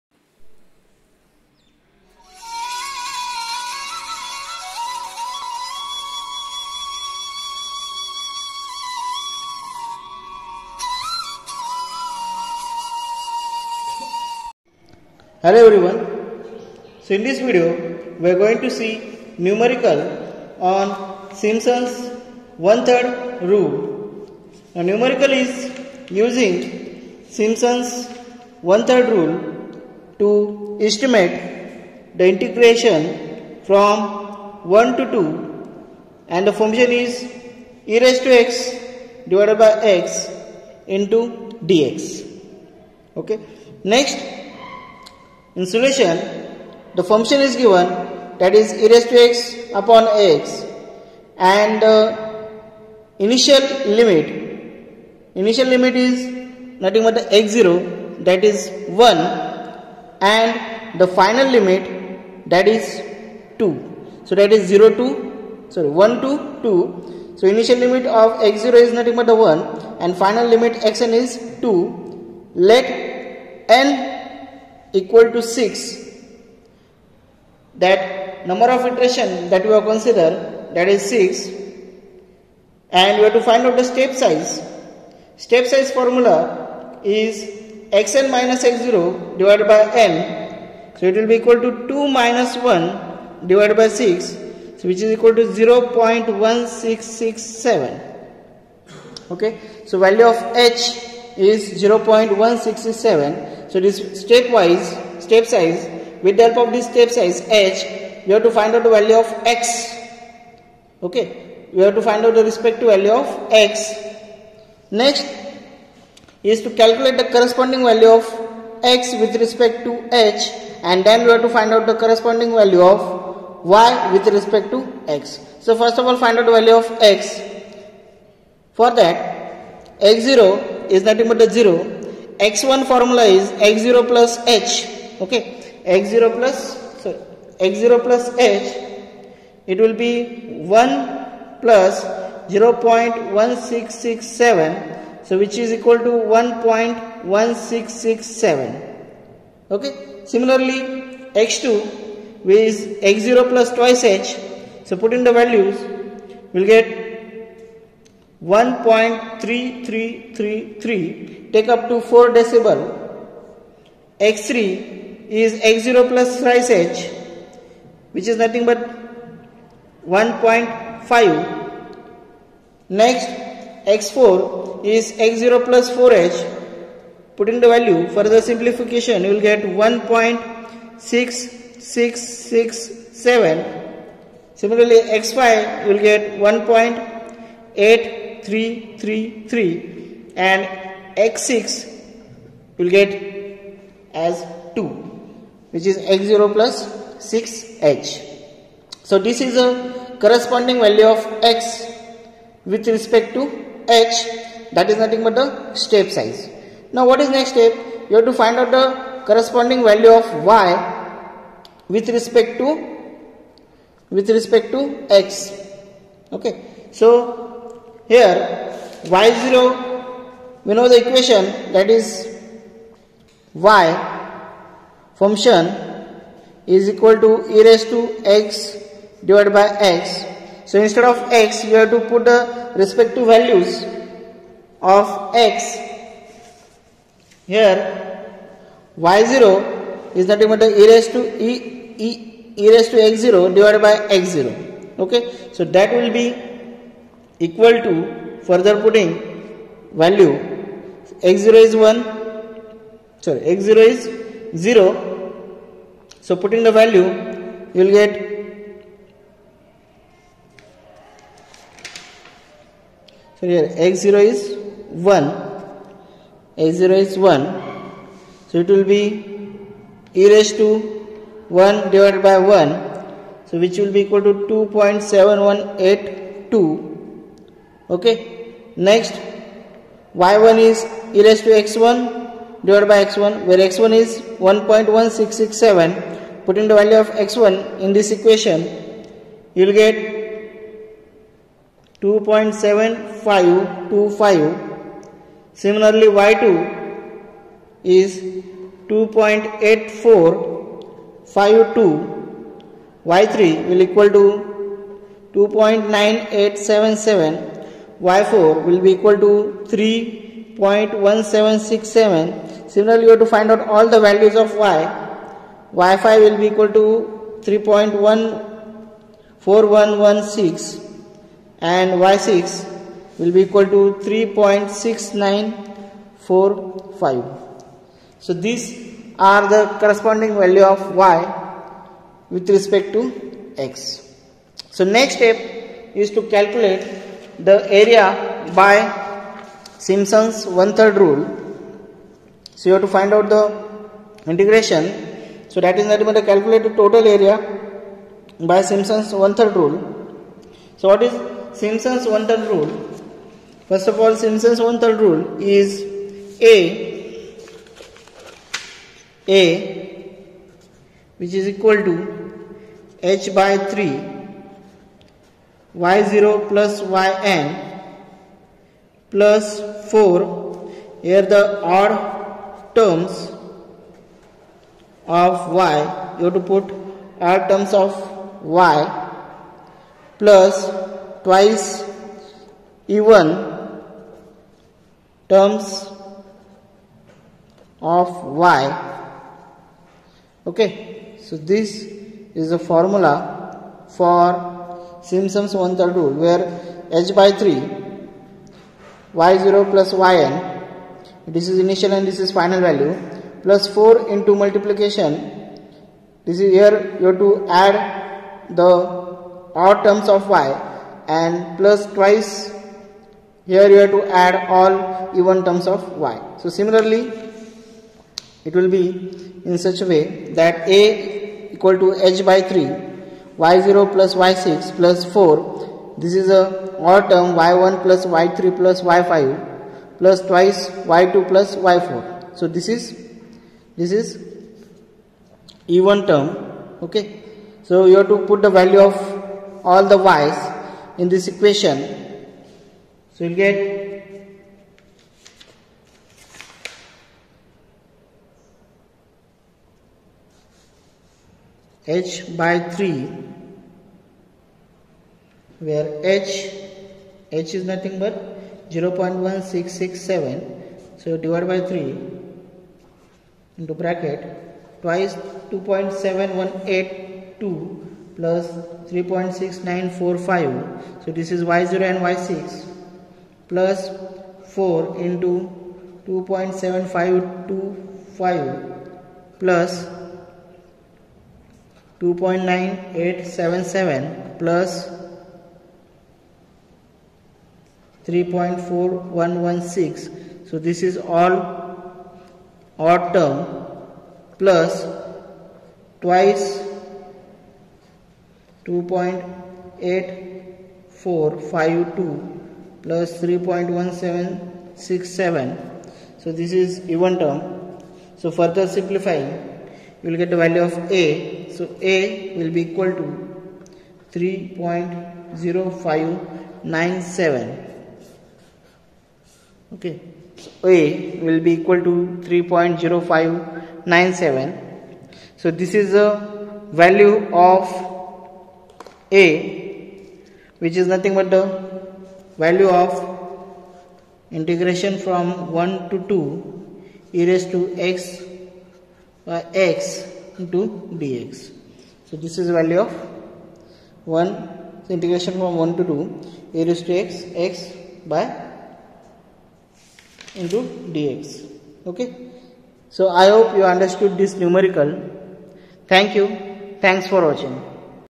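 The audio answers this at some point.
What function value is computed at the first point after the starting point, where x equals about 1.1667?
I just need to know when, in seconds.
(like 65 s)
292 s.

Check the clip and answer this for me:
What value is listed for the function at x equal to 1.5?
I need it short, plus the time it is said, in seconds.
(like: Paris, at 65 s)
2.9877, at 304 s.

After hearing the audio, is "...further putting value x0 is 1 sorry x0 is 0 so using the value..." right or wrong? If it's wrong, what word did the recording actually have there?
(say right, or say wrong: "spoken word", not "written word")
wrong: "putting", not "using".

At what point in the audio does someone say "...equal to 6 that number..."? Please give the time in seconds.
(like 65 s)
74 s.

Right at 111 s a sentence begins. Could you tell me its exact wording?
Okay, we have to find out the respective value of x.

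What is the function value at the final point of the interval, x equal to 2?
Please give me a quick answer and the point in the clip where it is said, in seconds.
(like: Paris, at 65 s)
3.6945, at 324 s.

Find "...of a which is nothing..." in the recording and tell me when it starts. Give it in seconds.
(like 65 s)
527 s.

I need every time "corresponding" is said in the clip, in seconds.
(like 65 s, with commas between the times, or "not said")
117 s, 121 s, 200 s, 209 s, 329 s.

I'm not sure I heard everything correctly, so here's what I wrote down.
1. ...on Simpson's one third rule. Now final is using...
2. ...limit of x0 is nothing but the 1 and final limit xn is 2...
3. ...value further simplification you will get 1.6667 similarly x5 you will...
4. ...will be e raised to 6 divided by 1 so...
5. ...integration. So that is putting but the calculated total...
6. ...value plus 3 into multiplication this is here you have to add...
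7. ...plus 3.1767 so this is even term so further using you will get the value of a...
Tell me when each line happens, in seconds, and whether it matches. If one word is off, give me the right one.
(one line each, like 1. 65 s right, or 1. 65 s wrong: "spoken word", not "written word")
1. 20 s wrong: "numerical", not "final"
2. 67 s right
3. 177 s right
4. 268 s wrong: "1", not "6"
5. 344 s wrong: "nothing", not "putting"
6. 402 s wrong: "4", not "3"
7. 502 s wrong: "simplifying", not "using".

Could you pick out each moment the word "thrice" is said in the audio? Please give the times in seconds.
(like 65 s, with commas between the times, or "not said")
166 s.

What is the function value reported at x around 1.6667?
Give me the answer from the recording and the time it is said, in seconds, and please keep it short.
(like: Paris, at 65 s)
3.1767, at 308 s.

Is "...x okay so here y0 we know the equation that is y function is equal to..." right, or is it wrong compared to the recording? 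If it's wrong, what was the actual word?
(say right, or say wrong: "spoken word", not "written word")
right.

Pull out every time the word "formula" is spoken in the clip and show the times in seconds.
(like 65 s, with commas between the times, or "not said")
85 s, 132 s, 392 s.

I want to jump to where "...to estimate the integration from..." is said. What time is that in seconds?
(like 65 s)
30 s.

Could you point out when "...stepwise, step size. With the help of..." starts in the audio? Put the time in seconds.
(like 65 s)
104 s.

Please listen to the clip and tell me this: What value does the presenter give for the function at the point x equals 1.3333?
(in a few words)
2.8452.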